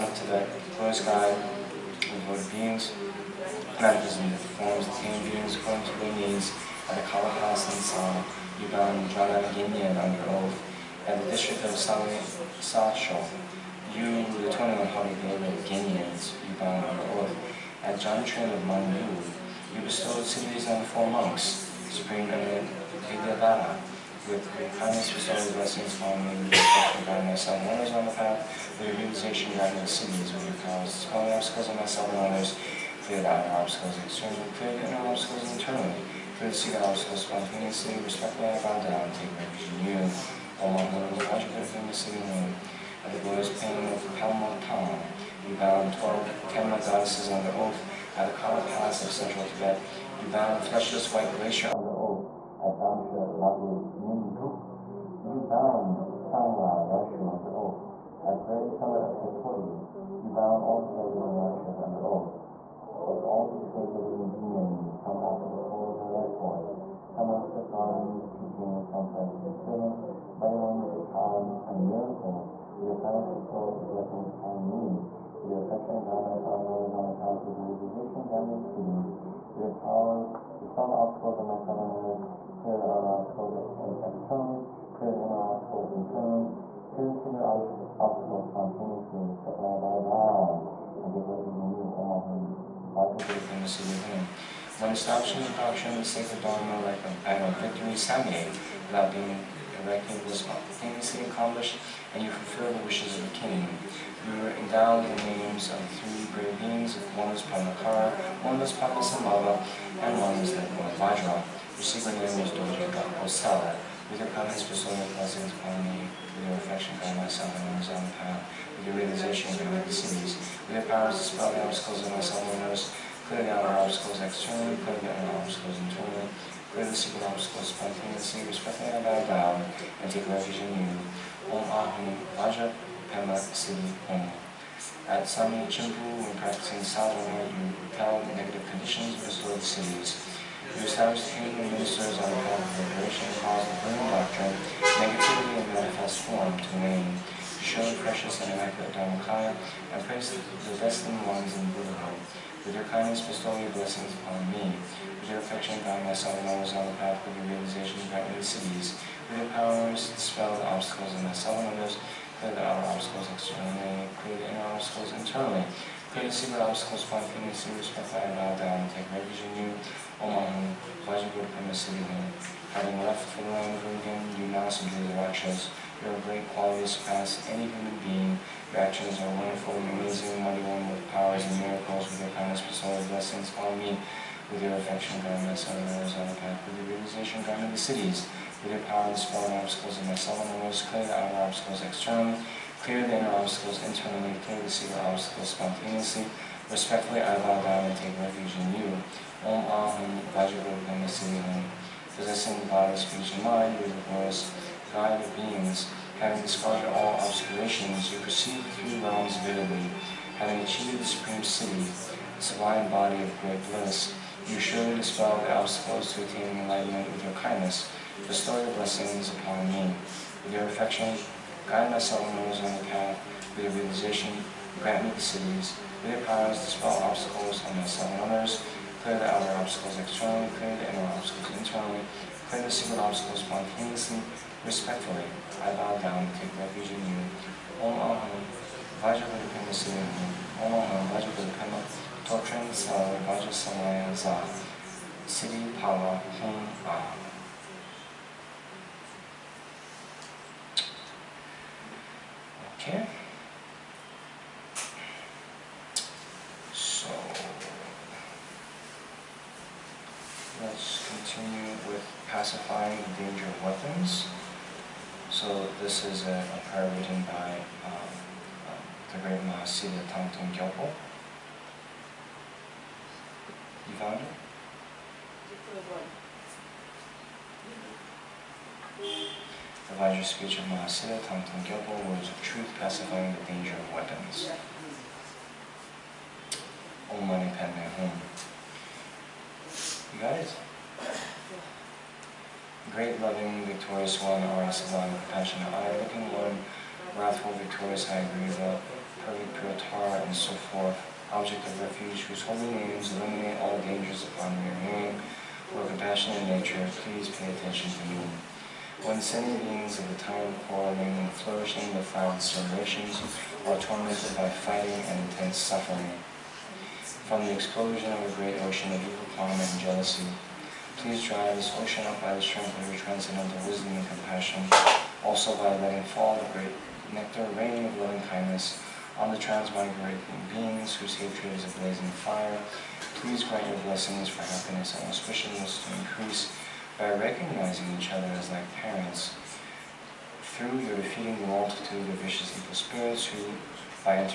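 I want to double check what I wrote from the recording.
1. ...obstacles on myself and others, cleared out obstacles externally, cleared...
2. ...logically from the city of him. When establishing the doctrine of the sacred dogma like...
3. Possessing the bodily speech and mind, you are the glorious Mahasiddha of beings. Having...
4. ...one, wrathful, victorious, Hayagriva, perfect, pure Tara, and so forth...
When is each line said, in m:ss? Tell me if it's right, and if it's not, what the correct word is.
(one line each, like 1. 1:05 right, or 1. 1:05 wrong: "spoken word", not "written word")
1. 0:31 right
2. 1:32 right
3. 3:22 wrong: "God", not "Mahasiddha"
4. 4:56 right.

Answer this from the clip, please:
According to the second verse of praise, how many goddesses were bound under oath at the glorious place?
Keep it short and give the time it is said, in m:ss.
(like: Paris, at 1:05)
12, at 0:46.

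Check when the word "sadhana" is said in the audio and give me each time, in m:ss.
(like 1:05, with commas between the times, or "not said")
2:16, 2:41.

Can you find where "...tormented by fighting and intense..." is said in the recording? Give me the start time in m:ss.
5:13.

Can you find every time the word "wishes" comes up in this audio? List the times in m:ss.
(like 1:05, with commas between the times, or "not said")
1:42.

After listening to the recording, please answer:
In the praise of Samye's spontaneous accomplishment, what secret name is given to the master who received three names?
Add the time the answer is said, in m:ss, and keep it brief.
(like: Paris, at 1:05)
Dojaka Osala, at 1:52.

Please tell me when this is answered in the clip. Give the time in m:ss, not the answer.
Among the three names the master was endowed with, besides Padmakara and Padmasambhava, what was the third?
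1:50.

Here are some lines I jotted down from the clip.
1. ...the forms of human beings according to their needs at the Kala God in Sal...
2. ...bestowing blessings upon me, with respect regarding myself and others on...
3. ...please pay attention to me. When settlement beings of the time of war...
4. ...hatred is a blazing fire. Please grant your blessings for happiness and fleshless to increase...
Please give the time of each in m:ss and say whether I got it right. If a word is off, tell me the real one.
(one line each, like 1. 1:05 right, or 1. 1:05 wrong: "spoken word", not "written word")
1. 0:04 wrong: "House", not "God"
2. 0:25 right
3. 5:07 wrong: "sentient", not "settlement"
4. 5:31 wrong: "auspiciousness", not "fleshless".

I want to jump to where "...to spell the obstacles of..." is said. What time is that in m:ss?
2:01.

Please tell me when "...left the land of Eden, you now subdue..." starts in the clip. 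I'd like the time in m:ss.
2:53.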